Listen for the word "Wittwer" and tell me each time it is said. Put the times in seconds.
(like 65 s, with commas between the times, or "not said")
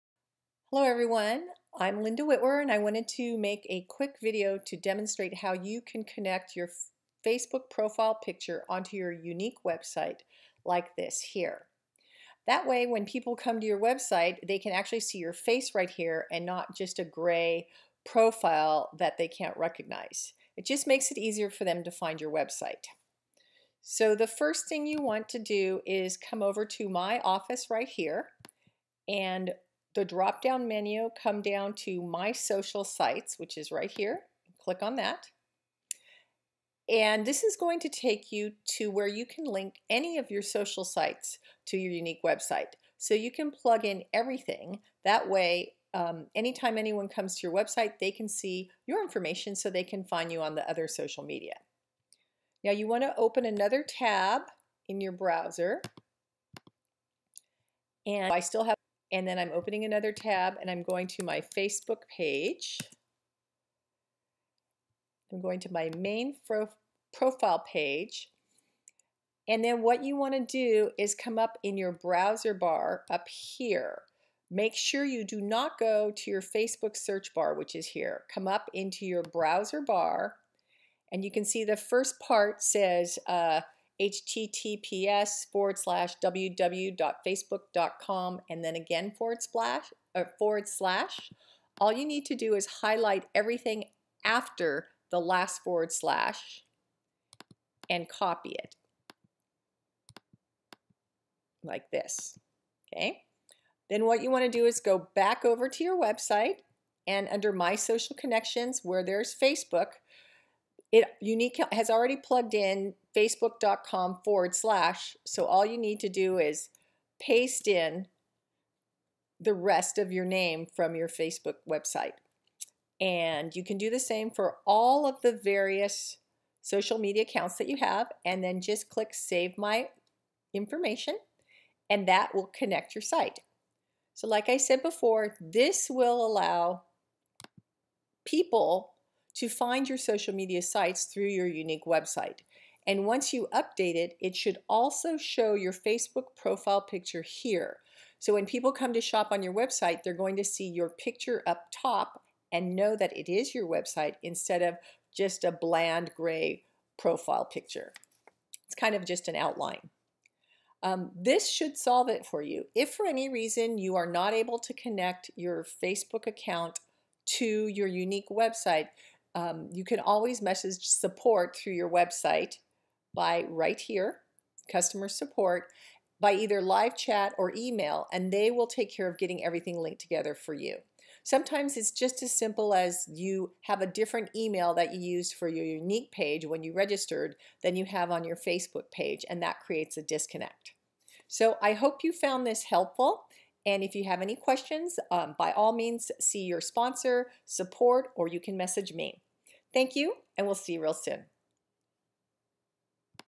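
2 s.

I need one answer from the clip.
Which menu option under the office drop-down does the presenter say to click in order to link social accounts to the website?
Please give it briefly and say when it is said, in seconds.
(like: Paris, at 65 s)
My Social Sites, at 32 s.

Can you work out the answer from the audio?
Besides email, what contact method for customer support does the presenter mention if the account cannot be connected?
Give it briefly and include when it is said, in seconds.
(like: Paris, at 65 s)
live chat, at 176 s.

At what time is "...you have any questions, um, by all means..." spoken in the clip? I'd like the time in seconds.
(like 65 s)
193 s.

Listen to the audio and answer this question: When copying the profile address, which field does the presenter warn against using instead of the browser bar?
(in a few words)
Facebook search bar.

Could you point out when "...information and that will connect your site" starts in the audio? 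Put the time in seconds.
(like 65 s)
130 s.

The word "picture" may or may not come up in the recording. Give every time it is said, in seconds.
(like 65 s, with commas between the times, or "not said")
8 s, 146 s, 150 s, 157 s.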